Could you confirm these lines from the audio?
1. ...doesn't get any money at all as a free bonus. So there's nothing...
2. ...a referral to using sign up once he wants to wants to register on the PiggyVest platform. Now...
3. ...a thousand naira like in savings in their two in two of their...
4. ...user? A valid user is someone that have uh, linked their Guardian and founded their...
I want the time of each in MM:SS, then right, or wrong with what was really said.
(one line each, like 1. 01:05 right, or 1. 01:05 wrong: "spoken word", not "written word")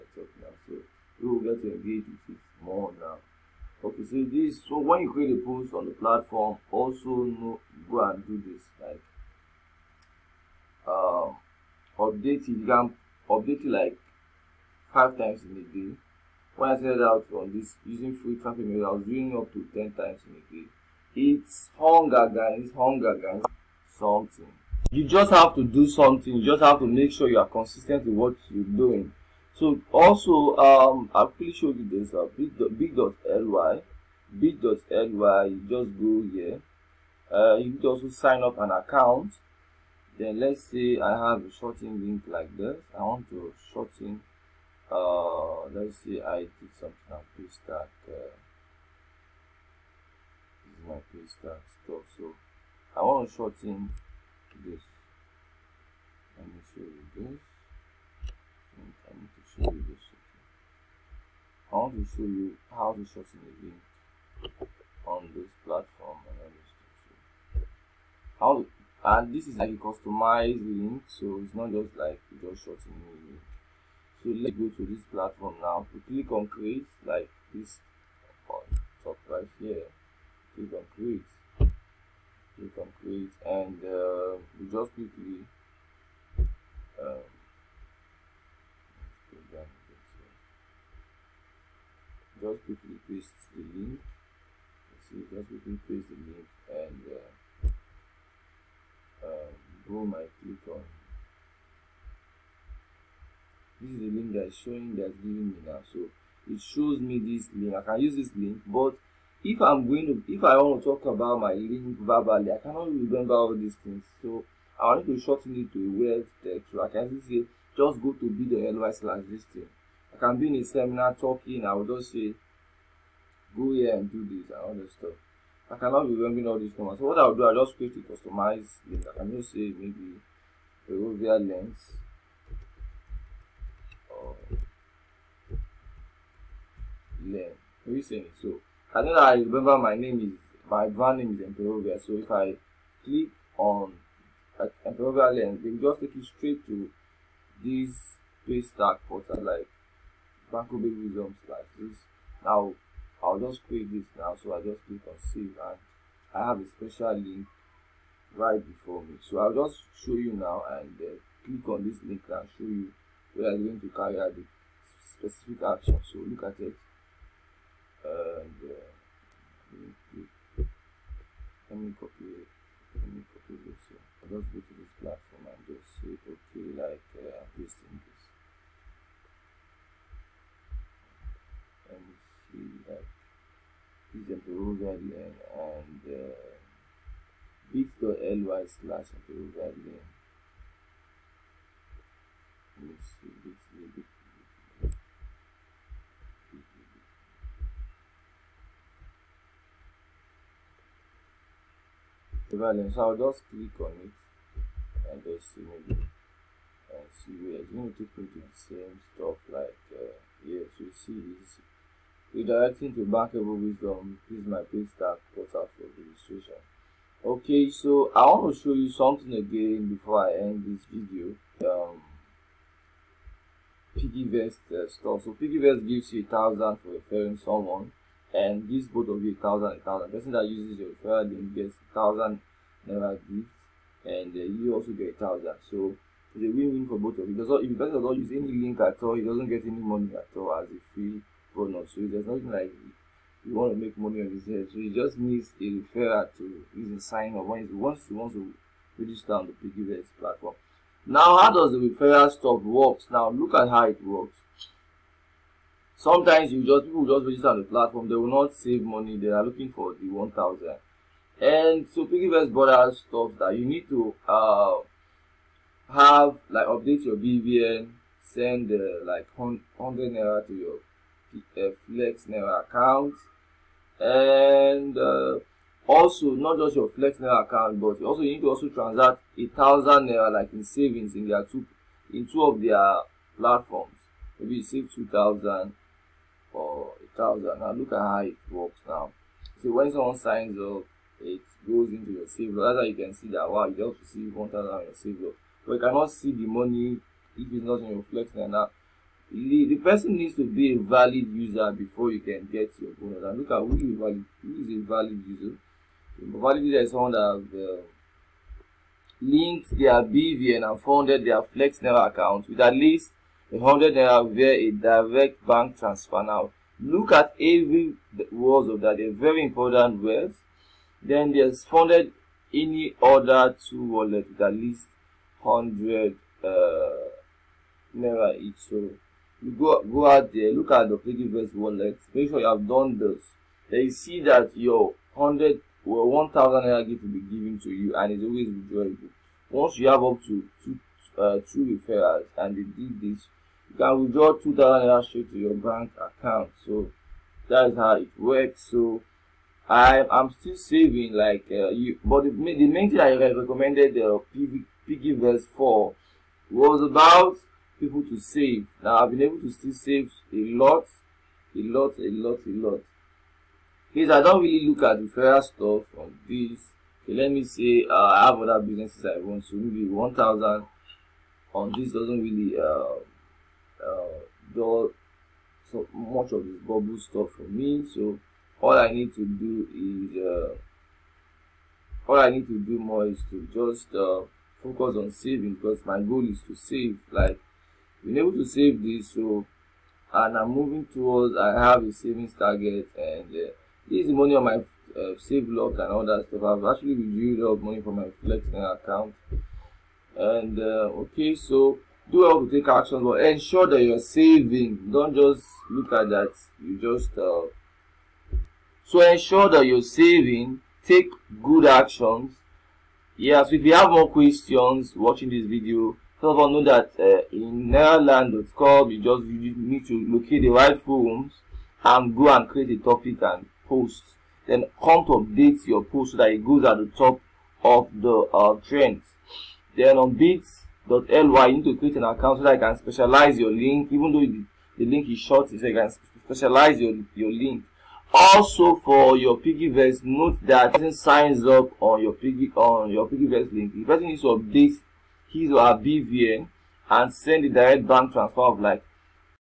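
1. 03:59 right
2. 04:05 right
3. 04:39 right
4. 05:05 wrong: "BVN", not "Guardian".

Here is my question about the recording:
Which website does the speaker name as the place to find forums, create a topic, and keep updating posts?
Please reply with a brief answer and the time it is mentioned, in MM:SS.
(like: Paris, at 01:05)
nairaland.com, at 06:57.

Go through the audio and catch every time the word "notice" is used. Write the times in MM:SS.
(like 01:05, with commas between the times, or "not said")
not said.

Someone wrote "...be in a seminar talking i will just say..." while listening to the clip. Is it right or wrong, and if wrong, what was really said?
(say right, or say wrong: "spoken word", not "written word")
right.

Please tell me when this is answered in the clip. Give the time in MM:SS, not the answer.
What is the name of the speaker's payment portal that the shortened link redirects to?
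03:33.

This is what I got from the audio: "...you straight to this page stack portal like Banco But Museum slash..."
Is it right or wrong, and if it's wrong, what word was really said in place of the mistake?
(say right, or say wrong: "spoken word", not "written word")
wrong: "Big", not "But".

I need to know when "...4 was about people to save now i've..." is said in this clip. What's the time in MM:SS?
05:55.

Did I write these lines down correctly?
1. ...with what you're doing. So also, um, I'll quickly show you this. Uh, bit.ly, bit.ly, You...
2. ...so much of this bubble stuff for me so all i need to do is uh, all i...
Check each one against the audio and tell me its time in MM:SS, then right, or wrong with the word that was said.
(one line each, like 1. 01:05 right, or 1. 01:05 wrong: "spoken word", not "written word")
1. 00:28 right
2. 06:15 right.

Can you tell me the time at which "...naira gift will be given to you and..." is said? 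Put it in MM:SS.
05:36.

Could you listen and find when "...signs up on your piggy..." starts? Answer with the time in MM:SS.
07:20.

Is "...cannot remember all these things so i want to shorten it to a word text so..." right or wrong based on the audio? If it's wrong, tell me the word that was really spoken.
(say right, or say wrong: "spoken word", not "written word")
right.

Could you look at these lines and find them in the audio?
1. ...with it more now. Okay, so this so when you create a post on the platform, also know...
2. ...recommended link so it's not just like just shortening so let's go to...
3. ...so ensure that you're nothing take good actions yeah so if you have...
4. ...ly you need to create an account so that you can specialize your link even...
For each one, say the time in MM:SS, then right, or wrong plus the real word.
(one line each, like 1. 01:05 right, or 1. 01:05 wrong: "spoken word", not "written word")
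1. 00:02 right
2. 01:09 wrong: "customized", not "recommended"
3. 06:48 wrong: "saving", not "nothing"
4. 07:10 right.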